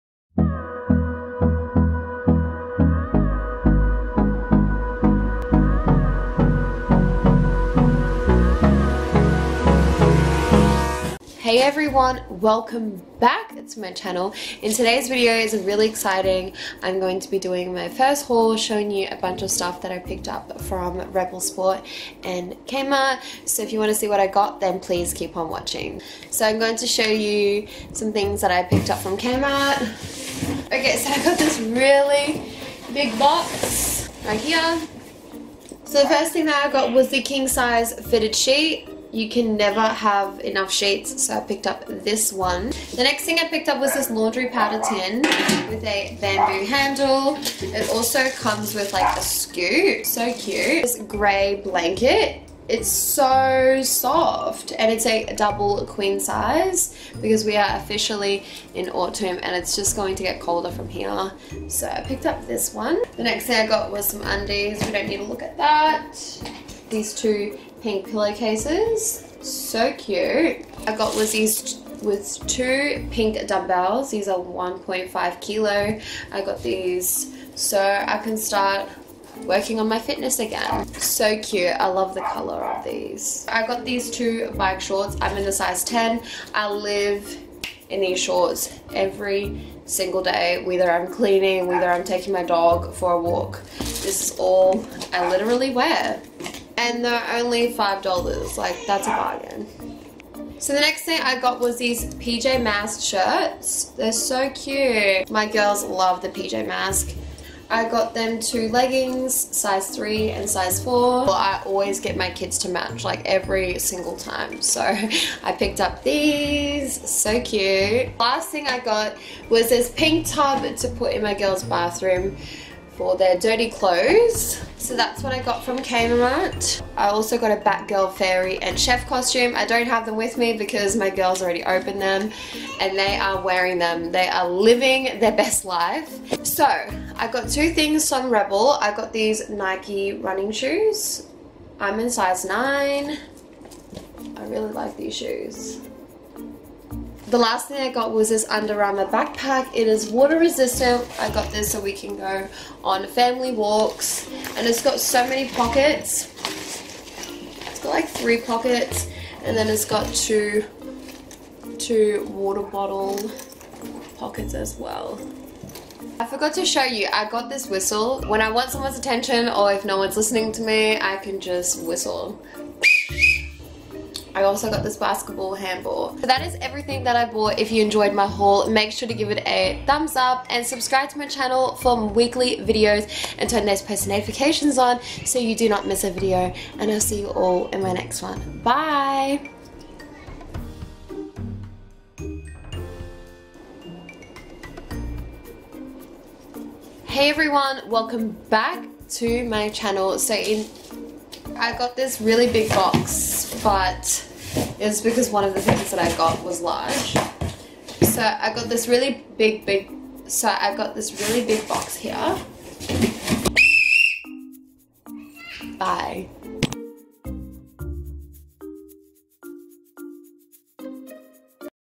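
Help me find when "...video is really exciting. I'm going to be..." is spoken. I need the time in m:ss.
0:15.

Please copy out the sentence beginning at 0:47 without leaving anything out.
It also comes with like a scoop, so cute.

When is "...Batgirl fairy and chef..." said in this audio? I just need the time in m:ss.
2:07.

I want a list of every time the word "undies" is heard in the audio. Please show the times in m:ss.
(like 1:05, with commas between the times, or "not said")
1:04.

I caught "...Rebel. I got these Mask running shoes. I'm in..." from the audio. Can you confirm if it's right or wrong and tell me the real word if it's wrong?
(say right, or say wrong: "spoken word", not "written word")
wrong: "Nike", not "Mask".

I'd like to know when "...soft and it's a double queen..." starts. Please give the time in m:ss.
0:53.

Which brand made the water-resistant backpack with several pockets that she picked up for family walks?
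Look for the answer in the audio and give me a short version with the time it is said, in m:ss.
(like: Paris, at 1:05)
Under Armour, at 2:28.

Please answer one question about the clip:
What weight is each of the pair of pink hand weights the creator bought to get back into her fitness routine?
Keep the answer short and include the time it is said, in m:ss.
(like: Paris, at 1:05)
1.5 kilo, at 1:14.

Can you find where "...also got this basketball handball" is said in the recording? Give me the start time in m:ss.
2:54.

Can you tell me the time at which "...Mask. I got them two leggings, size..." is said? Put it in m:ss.
1:46.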